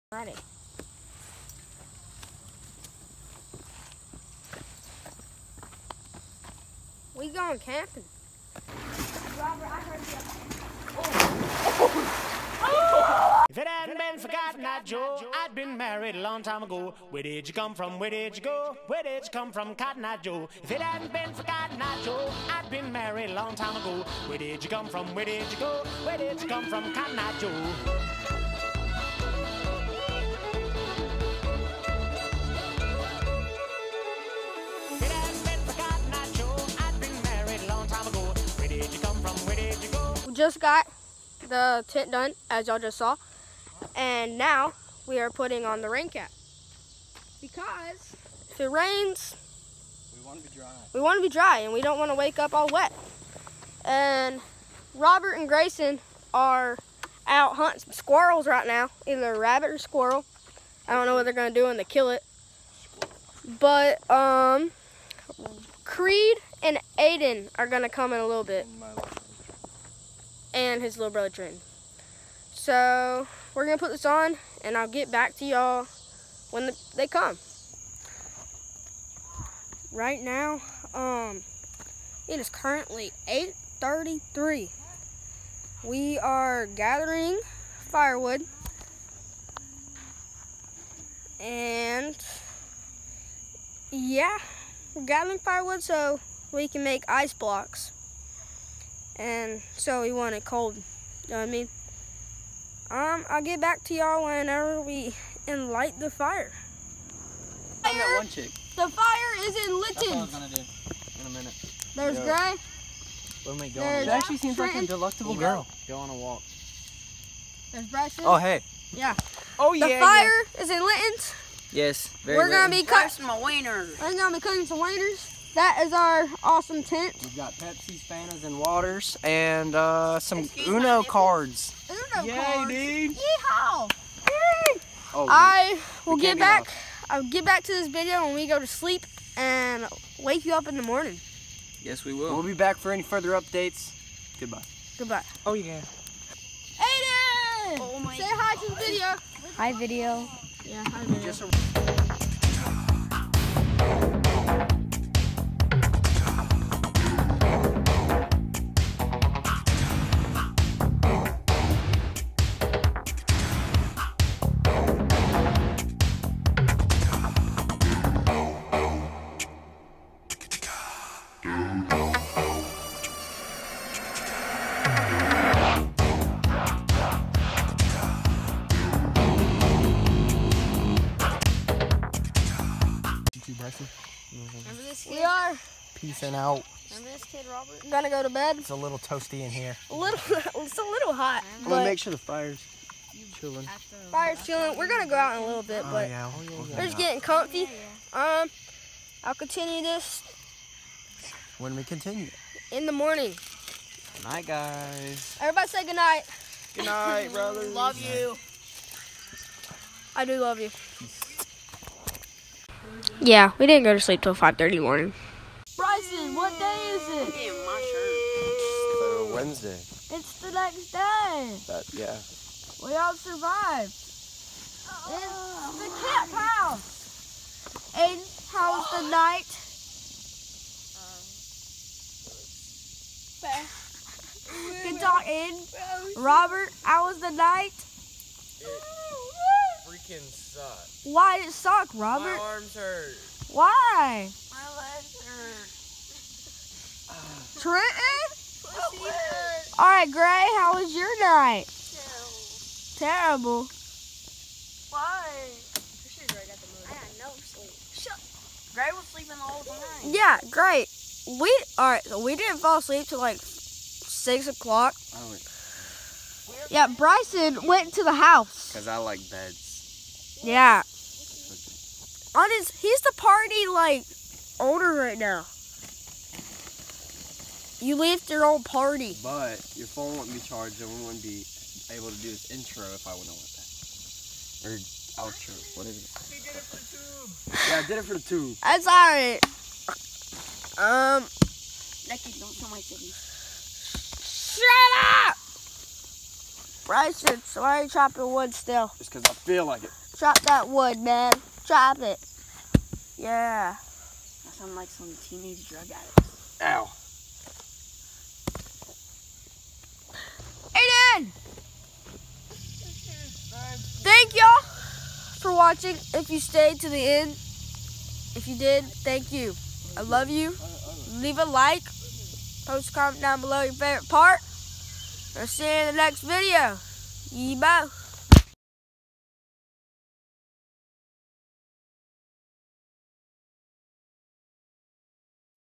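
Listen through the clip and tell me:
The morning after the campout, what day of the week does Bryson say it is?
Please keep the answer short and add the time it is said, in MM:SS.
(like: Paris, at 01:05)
Wednesday, at 03:39.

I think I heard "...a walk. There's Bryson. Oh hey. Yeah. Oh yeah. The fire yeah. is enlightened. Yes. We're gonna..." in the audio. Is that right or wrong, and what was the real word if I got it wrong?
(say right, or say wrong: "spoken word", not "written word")
right.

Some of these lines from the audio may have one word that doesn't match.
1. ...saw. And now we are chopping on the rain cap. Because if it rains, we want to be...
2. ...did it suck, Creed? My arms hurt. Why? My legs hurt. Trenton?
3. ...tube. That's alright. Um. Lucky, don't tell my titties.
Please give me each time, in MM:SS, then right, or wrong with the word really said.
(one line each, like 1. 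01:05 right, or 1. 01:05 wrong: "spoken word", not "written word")
1. 00:42 wrong: "putting", not "chopping"
2. 04:01 wrong: "Robert", not "Creed"
3. 04:48 right.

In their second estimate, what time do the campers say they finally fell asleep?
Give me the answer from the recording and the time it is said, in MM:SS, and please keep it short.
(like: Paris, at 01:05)
6 o'clock, at 04:23.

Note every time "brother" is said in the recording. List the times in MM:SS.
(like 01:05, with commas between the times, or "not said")
01:11, 03:27.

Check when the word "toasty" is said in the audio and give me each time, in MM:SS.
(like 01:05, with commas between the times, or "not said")
03:08.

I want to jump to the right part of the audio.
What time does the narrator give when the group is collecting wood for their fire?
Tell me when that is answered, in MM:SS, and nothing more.
01:23.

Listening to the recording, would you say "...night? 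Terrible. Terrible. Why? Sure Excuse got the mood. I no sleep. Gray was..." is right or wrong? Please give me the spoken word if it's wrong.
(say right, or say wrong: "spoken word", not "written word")
wrong: "Gray", not "Excuse".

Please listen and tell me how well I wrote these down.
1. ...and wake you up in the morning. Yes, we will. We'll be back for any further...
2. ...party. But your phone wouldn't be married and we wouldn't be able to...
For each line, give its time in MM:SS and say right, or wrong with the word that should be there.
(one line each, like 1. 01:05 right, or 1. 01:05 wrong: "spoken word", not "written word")
1. 02:19 right
2. 04:38 wrong: "charged", not "married".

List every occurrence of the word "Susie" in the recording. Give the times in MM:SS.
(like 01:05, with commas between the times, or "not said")
not said.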